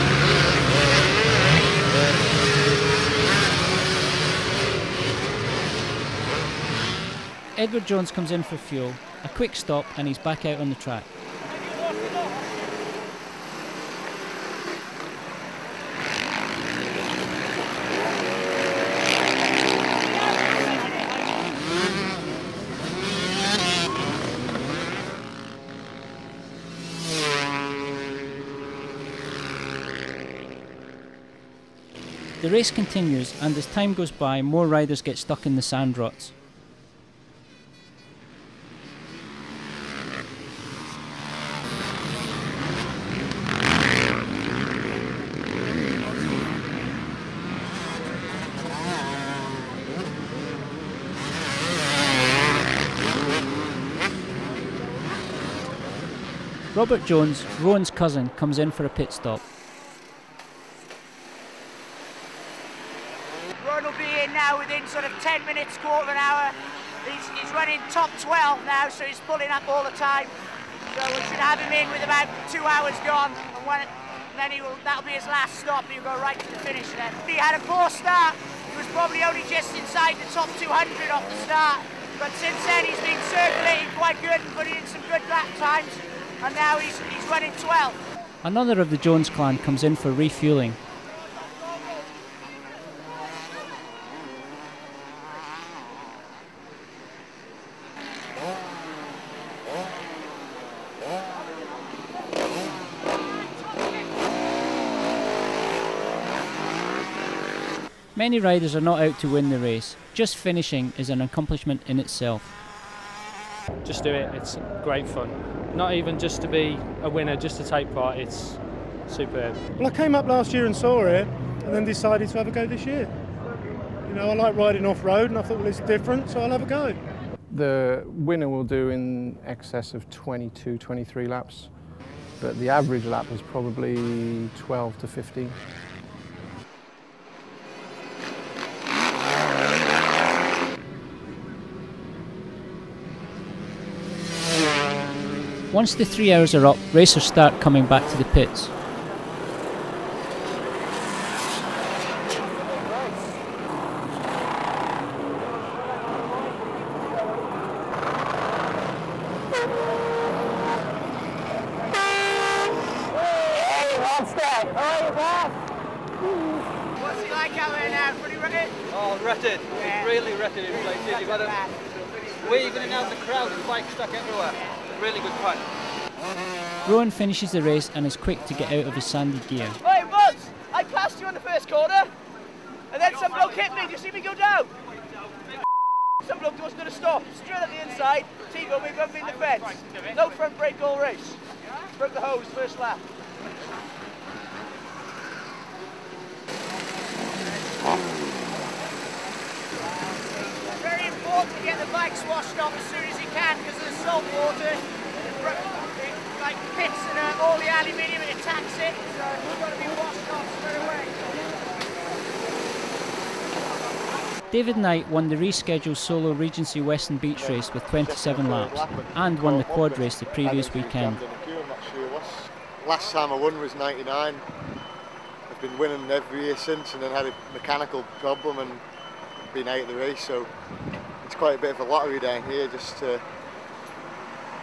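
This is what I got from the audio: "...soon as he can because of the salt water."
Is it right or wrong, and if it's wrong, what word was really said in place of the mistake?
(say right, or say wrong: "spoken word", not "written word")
right.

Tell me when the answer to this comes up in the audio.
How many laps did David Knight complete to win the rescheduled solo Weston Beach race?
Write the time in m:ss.
3:37.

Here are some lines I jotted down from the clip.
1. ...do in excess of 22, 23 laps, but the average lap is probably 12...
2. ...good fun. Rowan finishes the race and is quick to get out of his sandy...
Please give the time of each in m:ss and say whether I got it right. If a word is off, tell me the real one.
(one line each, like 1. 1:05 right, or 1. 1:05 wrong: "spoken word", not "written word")
1. 2:08 right
2. 2:55 right.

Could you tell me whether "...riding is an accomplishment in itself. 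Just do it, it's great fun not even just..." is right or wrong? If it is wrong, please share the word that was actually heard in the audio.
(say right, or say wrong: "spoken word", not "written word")
wrong: "finishing", not "riding".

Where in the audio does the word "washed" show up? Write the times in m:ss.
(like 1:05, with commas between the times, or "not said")
3:22, 3:29.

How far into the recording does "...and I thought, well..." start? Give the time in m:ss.
2:05.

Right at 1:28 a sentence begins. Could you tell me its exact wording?
Another of the Jones clan comes in for refueling.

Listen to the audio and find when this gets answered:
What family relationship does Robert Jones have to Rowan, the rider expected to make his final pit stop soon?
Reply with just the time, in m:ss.
0:57.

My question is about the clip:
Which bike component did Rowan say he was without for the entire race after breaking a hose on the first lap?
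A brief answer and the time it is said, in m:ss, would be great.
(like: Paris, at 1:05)
Front brake, at 3:10.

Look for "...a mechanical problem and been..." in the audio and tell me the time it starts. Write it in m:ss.
3:47.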